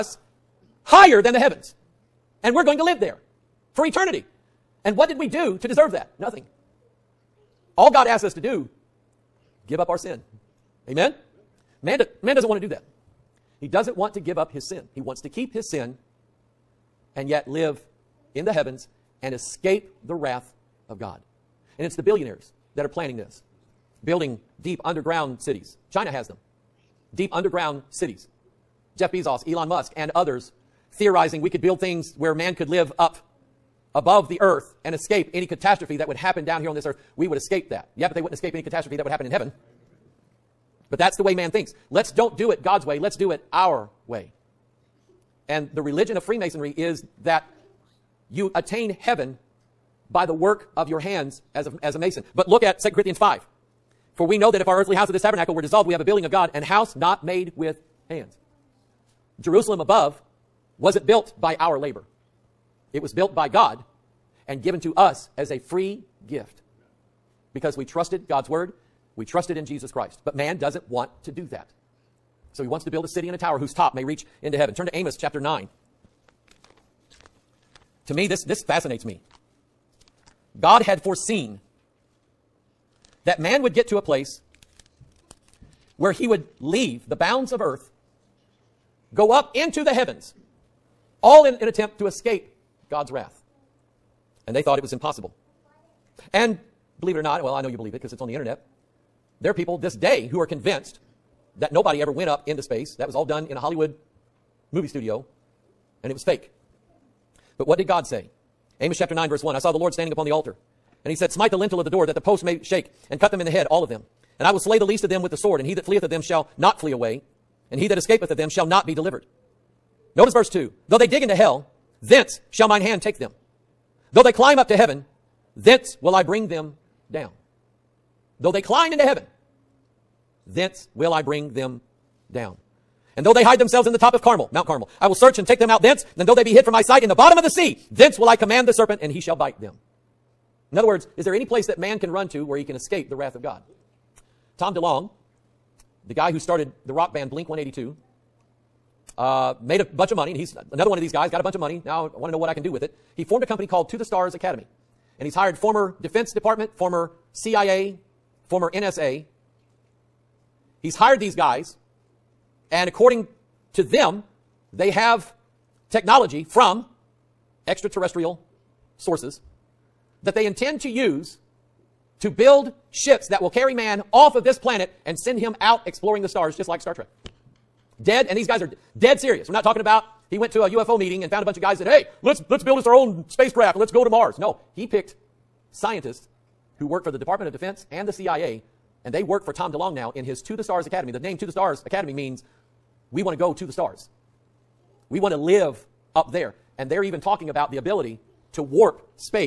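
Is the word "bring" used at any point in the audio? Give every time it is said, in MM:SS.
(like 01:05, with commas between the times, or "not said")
02:06, 02:11.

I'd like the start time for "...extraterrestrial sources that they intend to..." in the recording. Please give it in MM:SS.
02:47.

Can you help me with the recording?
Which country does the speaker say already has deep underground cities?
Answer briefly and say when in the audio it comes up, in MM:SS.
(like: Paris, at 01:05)
China, at 00:25.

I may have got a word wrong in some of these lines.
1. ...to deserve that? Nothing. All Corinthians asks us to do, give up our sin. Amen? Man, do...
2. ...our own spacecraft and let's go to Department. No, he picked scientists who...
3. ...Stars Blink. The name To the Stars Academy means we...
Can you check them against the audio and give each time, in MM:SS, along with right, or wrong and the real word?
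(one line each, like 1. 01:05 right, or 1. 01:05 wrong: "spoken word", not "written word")
1. 00:05 wrong: "God", not "Corinthians"
2. 03:02 wrong: "Mars", not "Department"
3. 03:10 wrong: "Academy", not "Blink".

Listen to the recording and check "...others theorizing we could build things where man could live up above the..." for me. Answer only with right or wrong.
right.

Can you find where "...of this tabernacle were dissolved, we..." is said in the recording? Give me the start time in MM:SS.
00:55.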